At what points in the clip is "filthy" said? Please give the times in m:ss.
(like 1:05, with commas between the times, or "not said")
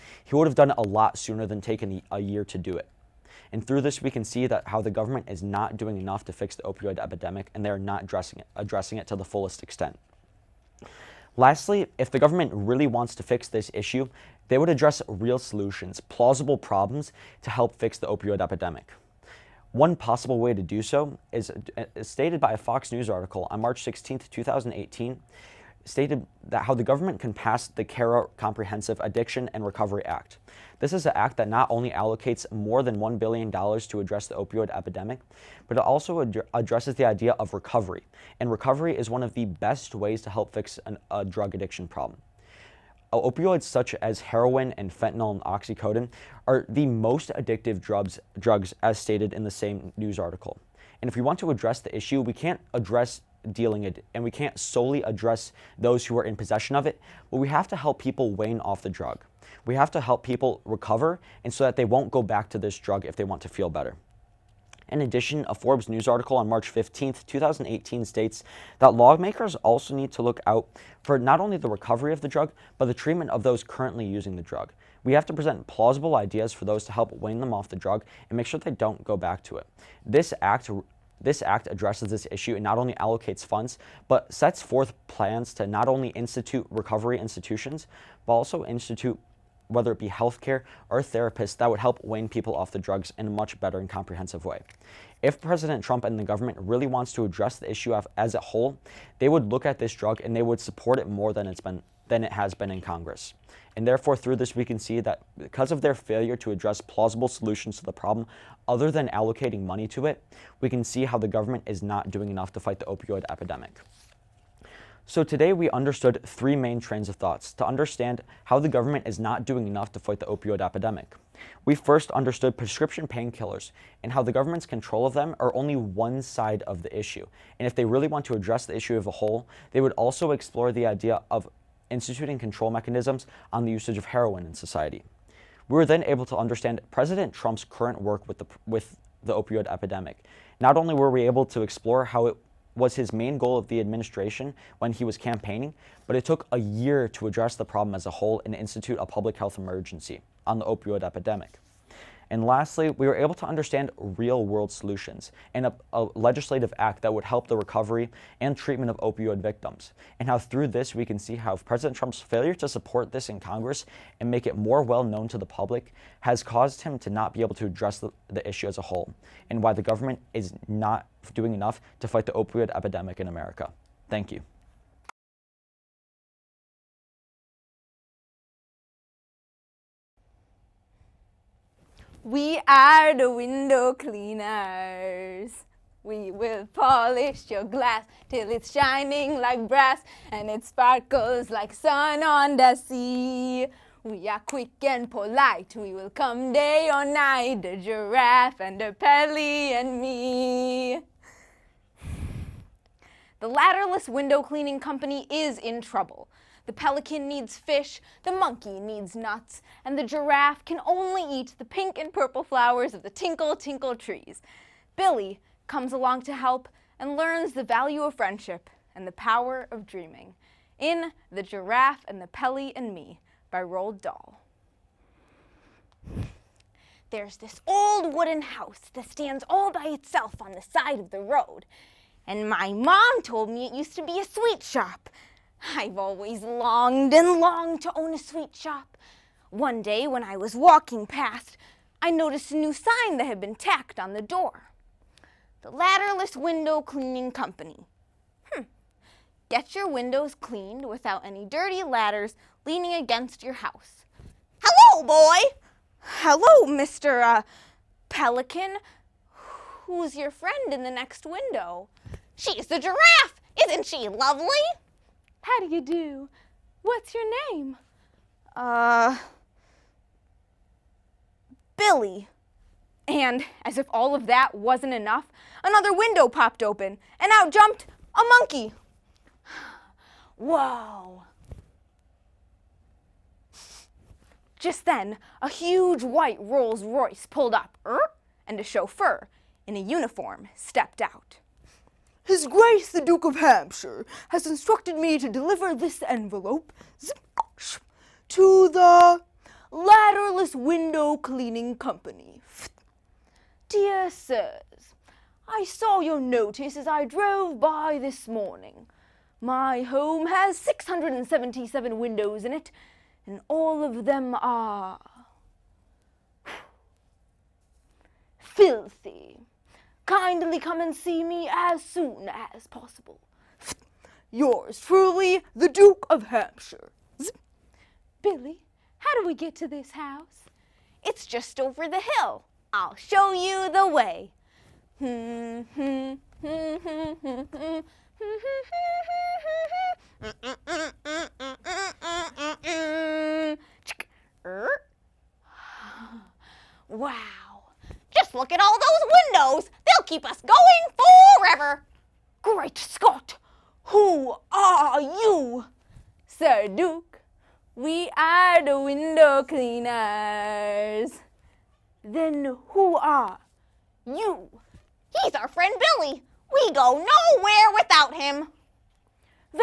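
5:18.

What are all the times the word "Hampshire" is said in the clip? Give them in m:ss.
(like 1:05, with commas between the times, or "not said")
4:53, 5:26.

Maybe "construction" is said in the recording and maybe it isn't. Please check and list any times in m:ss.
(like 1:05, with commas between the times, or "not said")
not said.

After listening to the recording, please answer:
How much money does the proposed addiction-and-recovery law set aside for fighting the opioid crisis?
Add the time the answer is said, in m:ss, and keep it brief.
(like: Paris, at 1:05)
More than $1 billion, at 0:32.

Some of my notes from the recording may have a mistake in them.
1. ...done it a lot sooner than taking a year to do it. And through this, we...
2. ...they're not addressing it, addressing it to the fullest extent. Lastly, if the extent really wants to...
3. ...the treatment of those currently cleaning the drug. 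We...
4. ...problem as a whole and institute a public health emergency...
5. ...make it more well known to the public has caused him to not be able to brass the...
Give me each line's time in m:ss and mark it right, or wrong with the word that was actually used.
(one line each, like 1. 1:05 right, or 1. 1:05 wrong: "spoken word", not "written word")
1. 0:00 right
2. 0:07 wrong: "government", not "extent"
3. 1:12 wrong: "using", not "cleaning"
4. 2:27 right
5. 2:44 wrong: "address", not "brass".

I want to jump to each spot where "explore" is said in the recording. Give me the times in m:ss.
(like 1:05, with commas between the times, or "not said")
2:10, 2:21.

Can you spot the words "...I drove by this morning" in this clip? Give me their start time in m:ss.
5:06.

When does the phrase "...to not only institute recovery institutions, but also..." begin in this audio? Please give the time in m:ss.
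1:25.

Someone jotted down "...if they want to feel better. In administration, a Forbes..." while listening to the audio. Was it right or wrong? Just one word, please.
wrong.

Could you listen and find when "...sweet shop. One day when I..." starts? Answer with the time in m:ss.
3:58.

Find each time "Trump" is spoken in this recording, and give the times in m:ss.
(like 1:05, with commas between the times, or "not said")
1:35, 2:17, 2:41.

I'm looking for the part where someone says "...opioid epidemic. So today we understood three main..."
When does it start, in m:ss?
1:52.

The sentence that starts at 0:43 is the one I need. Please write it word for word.
Opioids such as heroin and fentanyl and oxycodone are the most addictive drugs, drugs as stated in the same news article.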